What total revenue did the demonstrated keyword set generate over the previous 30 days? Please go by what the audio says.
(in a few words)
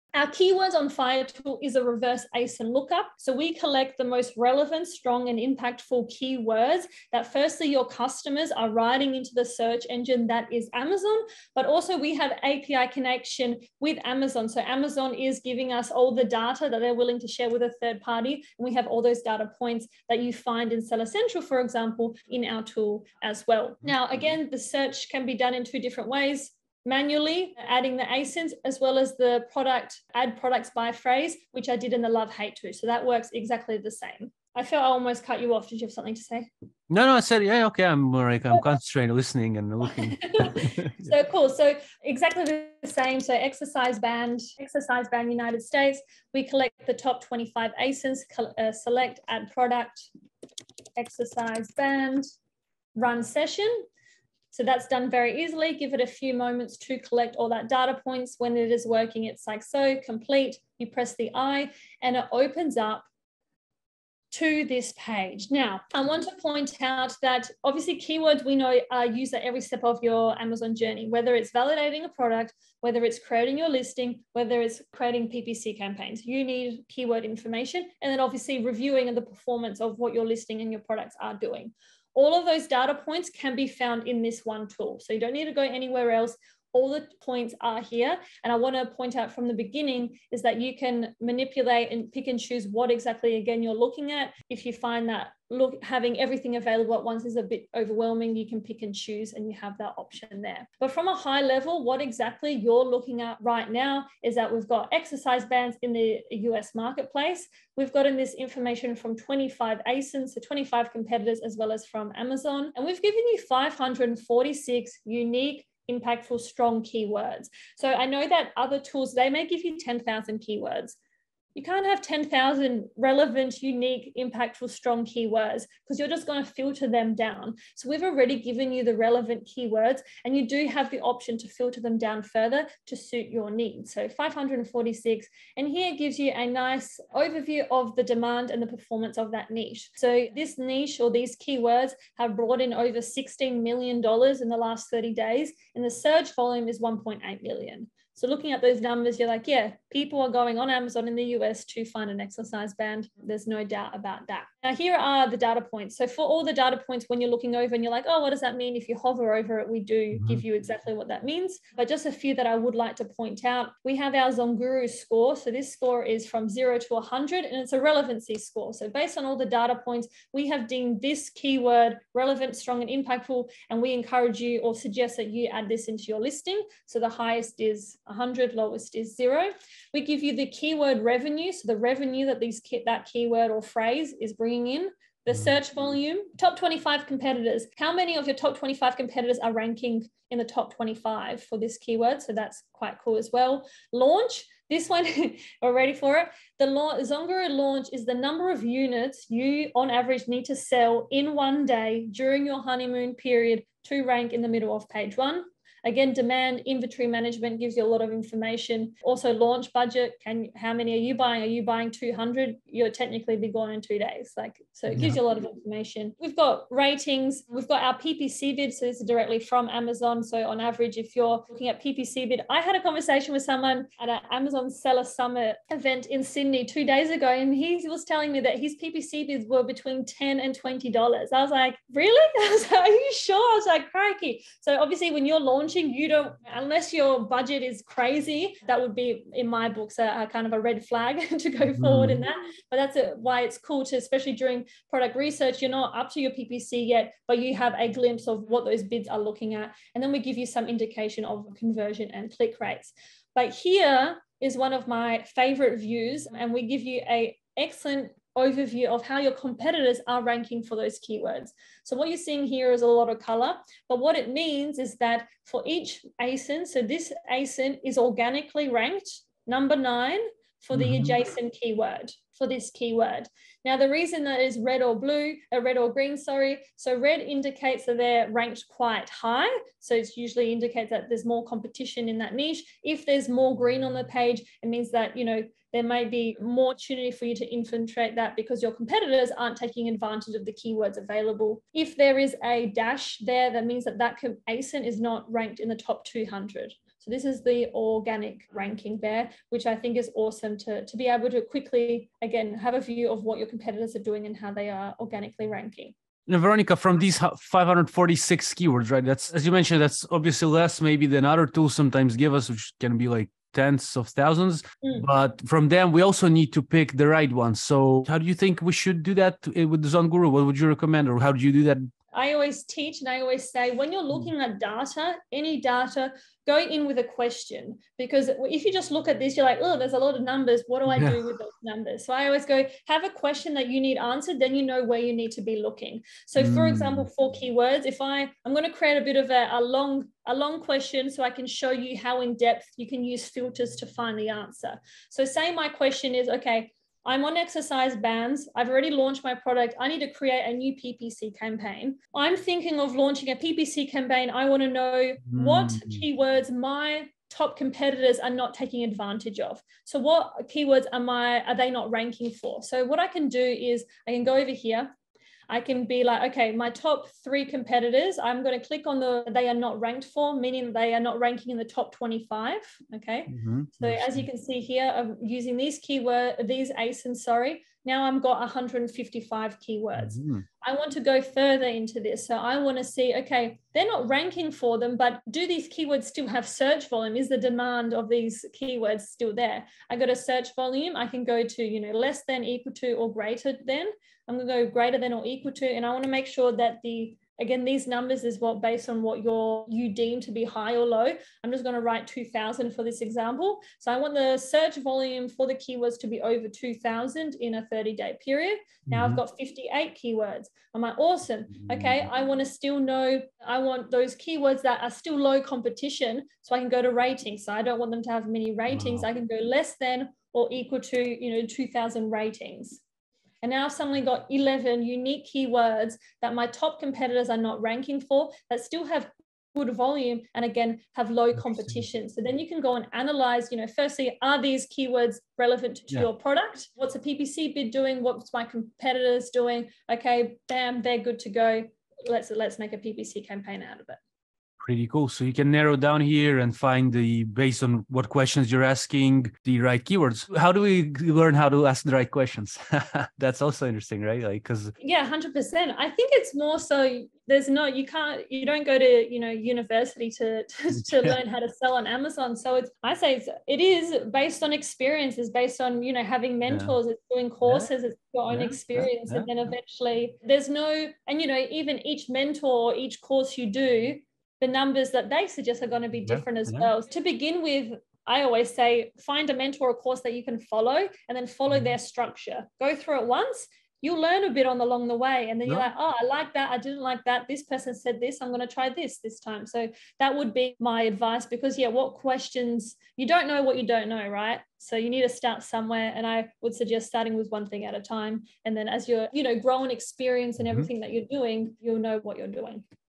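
Over $16 million.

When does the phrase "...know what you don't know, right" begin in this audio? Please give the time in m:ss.
8:13.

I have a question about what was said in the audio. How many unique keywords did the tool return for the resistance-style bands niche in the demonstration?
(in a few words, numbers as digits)
546.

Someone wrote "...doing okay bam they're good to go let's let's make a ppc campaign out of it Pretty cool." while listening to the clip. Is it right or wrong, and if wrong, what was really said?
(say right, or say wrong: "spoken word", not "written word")
right.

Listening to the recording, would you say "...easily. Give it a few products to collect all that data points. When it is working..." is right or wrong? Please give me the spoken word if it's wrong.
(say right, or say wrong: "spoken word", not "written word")
wrong: "moments", not "products".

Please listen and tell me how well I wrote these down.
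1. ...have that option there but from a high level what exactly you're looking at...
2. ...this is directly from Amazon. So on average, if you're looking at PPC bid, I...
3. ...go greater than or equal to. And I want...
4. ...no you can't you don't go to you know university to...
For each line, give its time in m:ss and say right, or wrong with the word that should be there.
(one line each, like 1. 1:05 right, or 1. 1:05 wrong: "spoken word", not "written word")
1. 1:39 right
2. 3:38 right
3. 6:34 right
4. 7:37 right.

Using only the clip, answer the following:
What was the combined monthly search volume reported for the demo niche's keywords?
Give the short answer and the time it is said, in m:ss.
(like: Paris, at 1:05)
1.8 million, at 2:26.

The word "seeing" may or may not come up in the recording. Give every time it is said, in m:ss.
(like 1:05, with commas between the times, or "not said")
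4:22.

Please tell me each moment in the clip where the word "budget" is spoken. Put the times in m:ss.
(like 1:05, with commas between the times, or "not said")
3:29, 3:57.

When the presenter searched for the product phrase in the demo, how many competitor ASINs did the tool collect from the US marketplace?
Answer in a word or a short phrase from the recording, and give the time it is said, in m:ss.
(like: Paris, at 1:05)
25, at 0:46.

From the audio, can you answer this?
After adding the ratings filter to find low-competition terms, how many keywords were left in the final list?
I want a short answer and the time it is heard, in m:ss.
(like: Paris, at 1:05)
11, at 7:04.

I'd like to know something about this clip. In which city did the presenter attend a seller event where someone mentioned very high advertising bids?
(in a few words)
Sydney.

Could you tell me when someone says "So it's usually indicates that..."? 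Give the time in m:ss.
4:39.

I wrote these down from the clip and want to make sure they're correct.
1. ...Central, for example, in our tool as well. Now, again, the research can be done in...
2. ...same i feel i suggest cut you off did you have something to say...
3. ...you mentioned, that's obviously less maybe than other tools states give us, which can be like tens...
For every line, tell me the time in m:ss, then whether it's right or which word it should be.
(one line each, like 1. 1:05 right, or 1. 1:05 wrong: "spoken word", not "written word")
1. 0:21 wrong: "search", not "research"
2. 0:33 wrong: "almost", not "suggest"
3. 5:09 wrong: "sometimes", not "states".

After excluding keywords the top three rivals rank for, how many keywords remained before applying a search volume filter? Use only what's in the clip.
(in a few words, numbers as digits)
155.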